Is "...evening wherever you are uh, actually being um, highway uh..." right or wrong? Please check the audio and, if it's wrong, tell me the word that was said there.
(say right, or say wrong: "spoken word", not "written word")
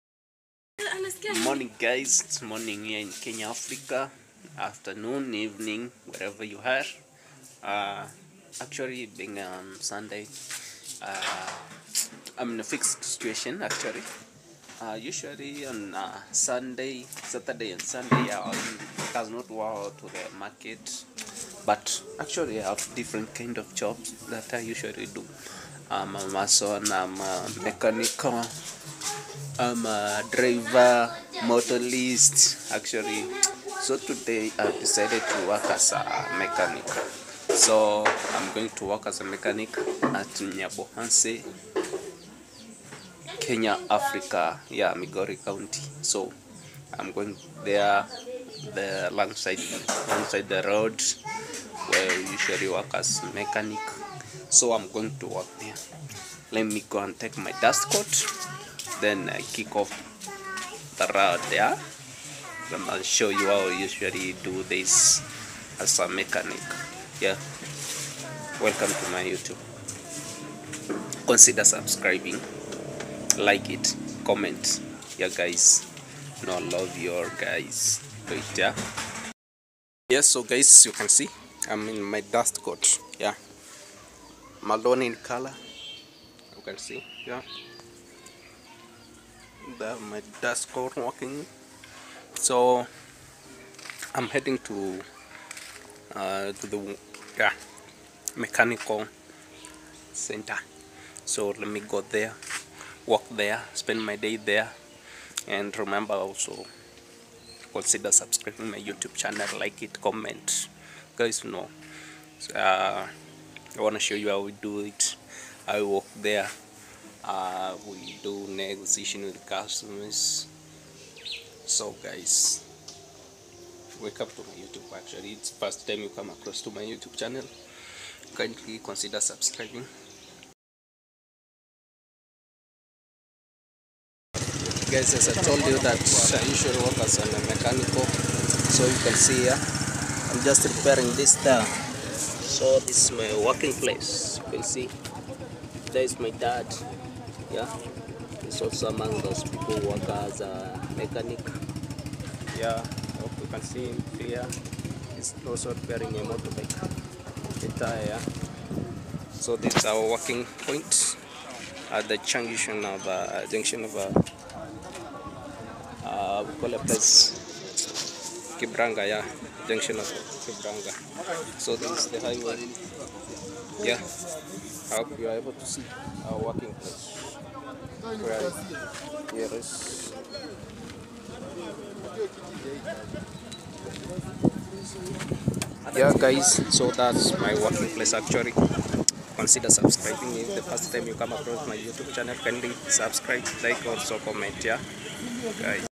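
wrong: "sunday", not "highway".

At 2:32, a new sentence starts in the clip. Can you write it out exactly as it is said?
Yeah, hope you can see him here He's also wearing a motorbike attire.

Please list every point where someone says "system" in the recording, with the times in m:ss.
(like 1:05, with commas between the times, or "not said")
not said.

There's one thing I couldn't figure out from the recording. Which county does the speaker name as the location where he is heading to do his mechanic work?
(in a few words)
Migori County.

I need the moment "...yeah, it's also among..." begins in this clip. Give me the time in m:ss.
2:27.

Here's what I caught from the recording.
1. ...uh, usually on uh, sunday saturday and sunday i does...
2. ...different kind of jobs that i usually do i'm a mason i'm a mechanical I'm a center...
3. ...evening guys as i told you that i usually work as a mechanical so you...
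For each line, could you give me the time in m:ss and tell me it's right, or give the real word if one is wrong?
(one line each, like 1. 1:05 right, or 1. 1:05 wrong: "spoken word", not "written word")
1. 0:14 right
2. 0:22 wrong: "driver", not "center"
3. 2:09 wrong: "subscribing", not "evening".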